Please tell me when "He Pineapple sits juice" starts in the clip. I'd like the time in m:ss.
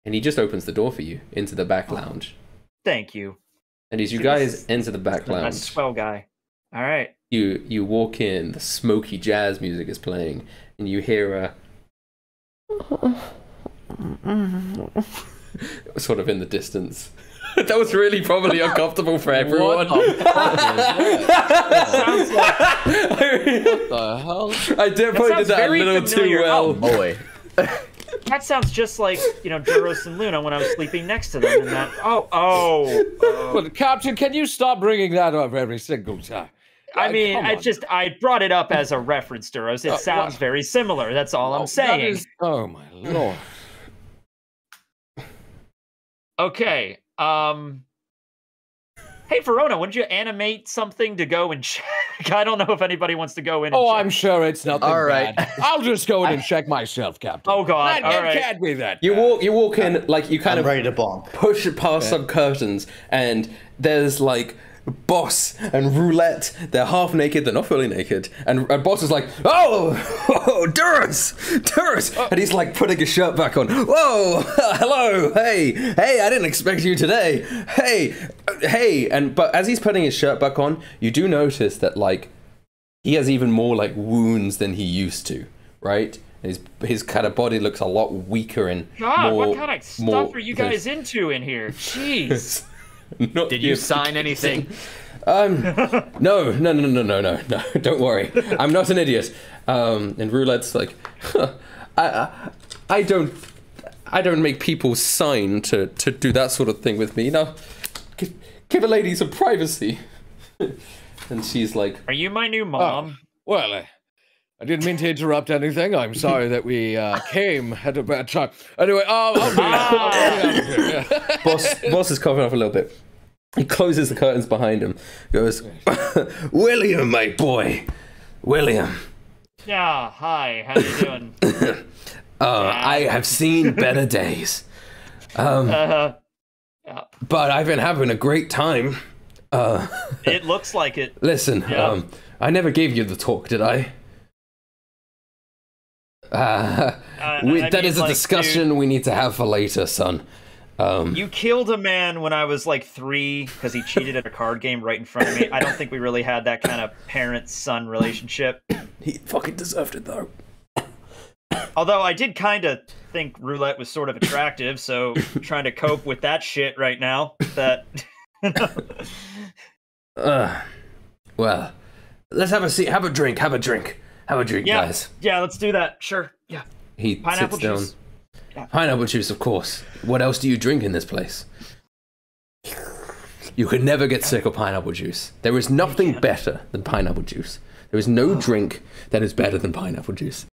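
2:56.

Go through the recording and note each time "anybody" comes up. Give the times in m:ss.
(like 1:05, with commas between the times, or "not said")
0:52.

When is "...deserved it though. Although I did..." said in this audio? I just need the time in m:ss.
2:39.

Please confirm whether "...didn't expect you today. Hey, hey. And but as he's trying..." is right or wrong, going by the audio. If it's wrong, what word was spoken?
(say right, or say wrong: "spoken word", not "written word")
wrong: "putting", not "trying".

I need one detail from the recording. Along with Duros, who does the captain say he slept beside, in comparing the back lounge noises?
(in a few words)
Luna.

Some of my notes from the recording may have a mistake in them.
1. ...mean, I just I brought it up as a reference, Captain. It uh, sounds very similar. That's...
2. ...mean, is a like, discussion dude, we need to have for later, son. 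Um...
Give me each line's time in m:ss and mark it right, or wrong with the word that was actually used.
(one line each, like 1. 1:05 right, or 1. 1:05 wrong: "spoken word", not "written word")
1. 0:37 wrong: "Duros", not "Captain"
2. 2:27 right.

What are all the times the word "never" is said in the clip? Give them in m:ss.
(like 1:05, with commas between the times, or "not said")
2:22, 3:03.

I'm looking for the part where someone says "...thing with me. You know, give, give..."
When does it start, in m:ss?
1:46.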